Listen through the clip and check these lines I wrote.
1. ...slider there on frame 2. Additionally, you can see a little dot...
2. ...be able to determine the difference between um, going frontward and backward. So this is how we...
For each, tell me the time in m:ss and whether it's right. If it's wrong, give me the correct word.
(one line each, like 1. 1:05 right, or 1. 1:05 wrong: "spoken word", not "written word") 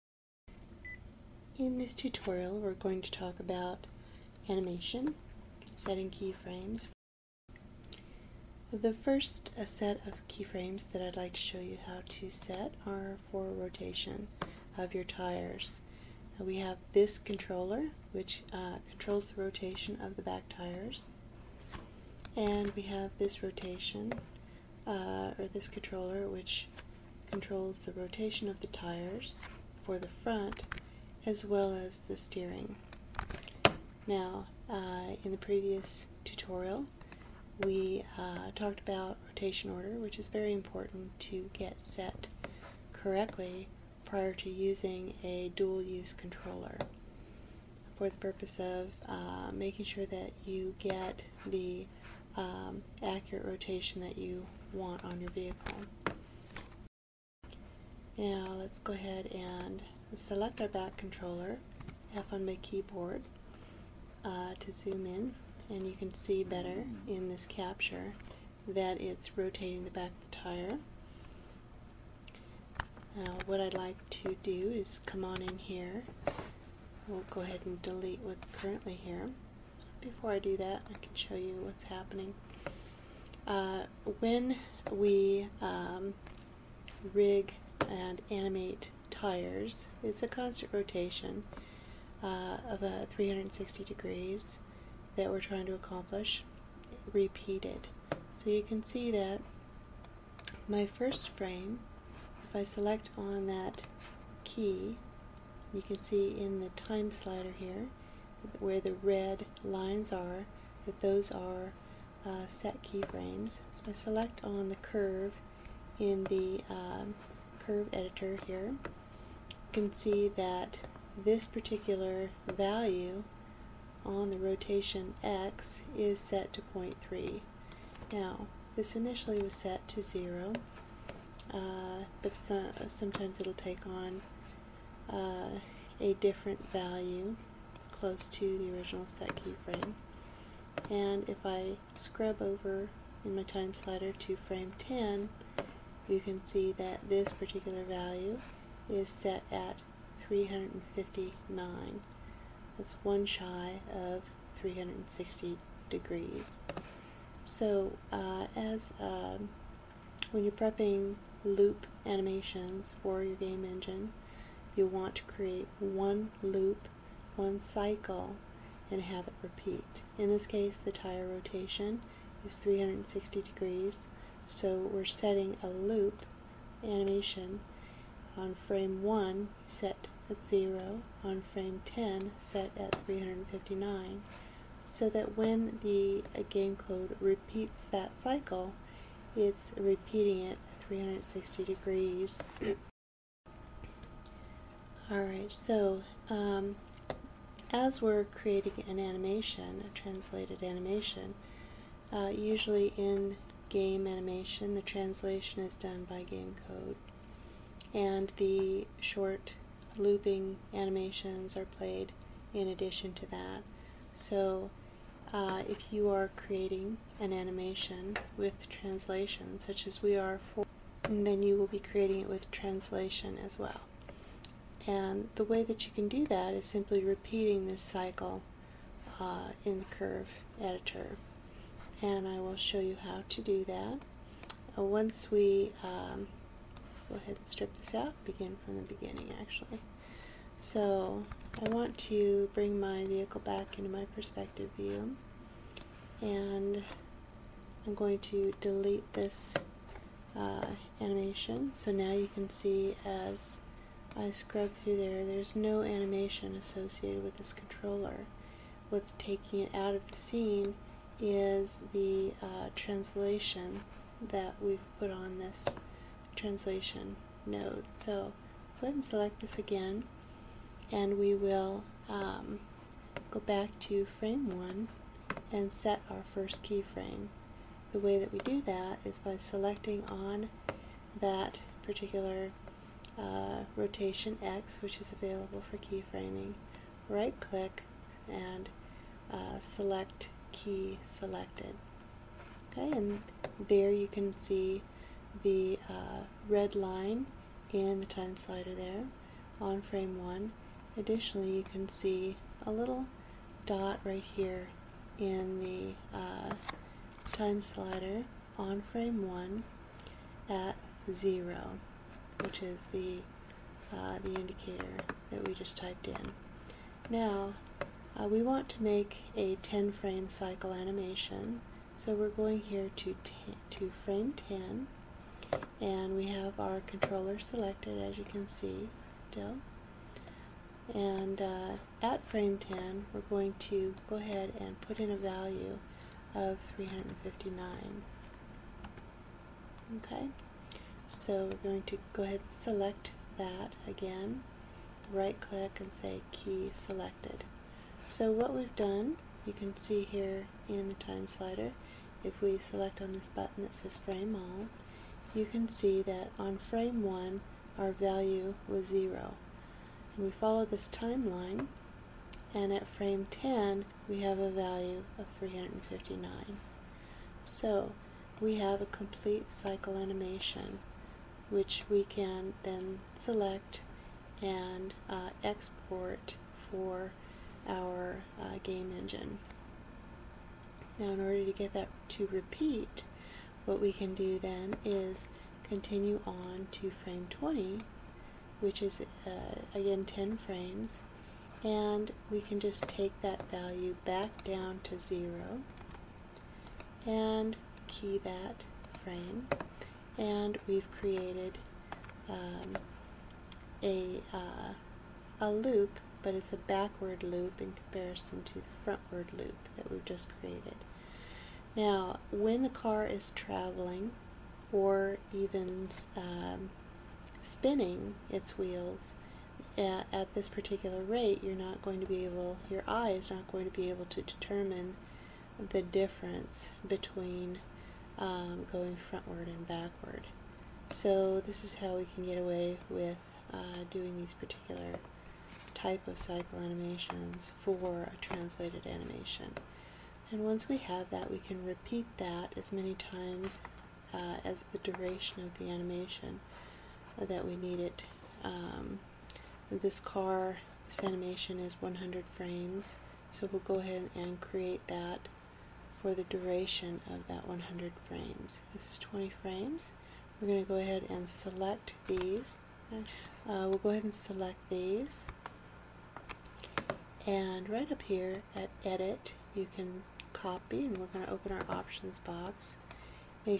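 1. 4:58 wrong: "1", not "2"
2. 7:03 right.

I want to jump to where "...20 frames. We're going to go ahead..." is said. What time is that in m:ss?
7:38.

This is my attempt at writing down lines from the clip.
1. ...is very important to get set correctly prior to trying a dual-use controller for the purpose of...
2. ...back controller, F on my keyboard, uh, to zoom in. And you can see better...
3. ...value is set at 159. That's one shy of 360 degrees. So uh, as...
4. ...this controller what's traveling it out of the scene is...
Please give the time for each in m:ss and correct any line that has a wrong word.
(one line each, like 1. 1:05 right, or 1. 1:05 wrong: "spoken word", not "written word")
1. 0:40 wrong: "using", not "trying"
2. 1:00 right
3. 2:27 wrong: "359", not "159"
4. 4:17 wrong: "taking", not "traveling".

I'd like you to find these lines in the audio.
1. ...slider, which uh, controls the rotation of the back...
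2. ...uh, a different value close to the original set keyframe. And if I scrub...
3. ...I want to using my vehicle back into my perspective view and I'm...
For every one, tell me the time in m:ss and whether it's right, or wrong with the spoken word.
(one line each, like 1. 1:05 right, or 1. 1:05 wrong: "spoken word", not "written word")
1. 0:17 wrong: "controller", not "slider"
2. 2:15 right
3. 4:01 wrong: "bring", not "using".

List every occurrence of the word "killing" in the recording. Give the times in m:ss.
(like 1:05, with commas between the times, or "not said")
not said.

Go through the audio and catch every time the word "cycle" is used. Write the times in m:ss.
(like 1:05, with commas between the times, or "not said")
2:47, 3:08, 3:47, 5:20, 6:09, 7:16.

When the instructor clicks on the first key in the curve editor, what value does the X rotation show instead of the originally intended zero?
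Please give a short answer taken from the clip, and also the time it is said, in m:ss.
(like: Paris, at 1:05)
0.3, at 2:06.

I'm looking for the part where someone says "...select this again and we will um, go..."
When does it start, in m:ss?
4:29.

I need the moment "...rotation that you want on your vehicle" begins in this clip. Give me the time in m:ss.
0:53.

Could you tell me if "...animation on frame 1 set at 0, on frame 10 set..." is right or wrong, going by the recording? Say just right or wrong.
right.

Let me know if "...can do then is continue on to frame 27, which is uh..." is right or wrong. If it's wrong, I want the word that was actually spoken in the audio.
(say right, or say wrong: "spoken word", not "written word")
wrong: "20", not "27".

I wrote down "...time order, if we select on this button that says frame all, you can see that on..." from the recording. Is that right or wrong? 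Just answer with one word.
wrong.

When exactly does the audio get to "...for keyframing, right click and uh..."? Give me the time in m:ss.
4:45.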